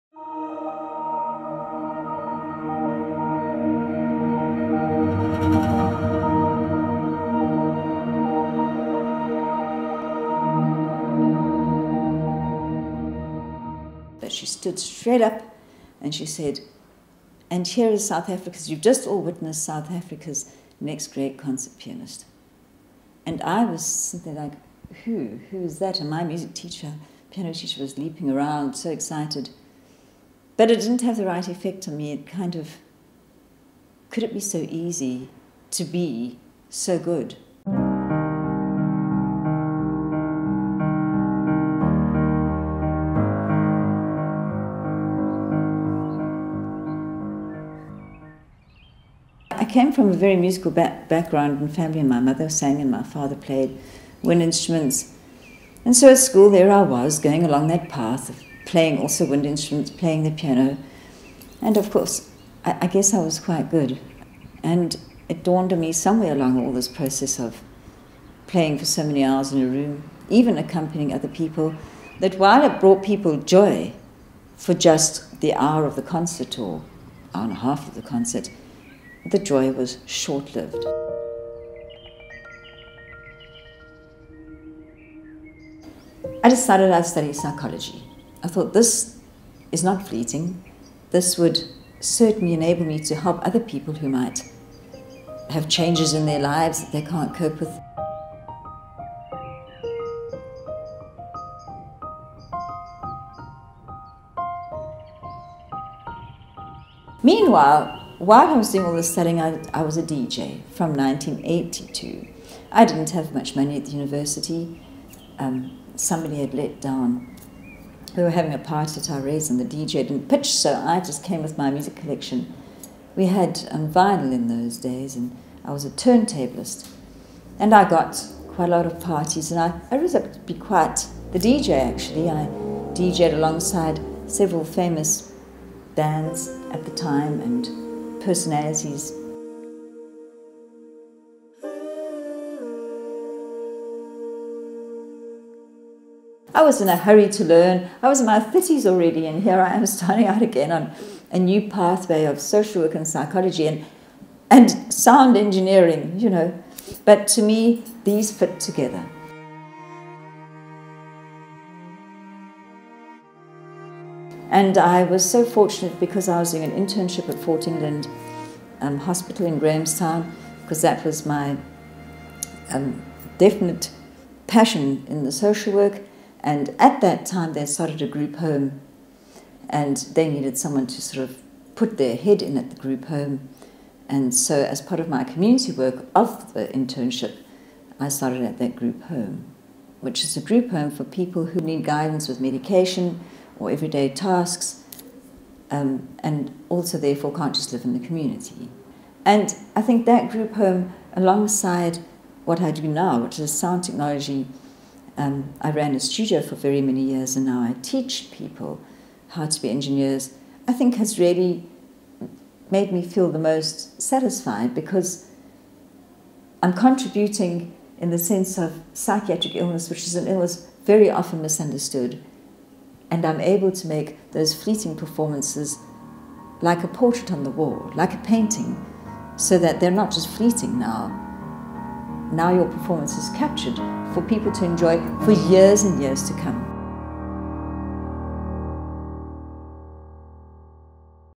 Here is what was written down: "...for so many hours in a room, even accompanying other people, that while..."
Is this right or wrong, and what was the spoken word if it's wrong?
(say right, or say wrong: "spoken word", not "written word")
right.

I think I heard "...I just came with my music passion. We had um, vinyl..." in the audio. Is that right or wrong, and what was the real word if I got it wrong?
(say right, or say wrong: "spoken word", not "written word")
wrong: "collection", not "passion".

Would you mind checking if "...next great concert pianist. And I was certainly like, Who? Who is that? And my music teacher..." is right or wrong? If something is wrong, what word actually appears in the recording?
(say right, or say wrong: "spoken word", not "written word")
wrong: "simply", not "certainly".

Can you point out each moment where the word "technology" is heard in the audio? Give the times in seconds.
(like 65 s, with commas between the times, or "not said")
203 s.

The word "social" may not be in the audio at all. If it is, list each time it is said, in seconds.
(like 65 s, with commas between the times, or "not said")
152 s, 175 s.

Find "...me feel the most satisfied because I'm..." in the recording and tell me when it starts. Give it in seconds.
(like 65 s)
212 s.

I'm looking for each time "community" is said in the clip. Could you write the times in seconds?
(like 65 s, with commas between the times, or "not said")
185 s, 198 s.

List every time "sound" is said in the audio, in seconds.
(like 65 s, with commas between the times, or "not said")
154 s, 203 s.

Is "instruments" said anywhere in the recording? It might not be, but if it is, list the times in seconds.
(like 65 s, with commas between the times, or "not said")
54 s, 59 s.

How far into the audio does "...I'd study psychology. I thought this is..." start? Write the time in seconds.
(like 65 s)
86 s.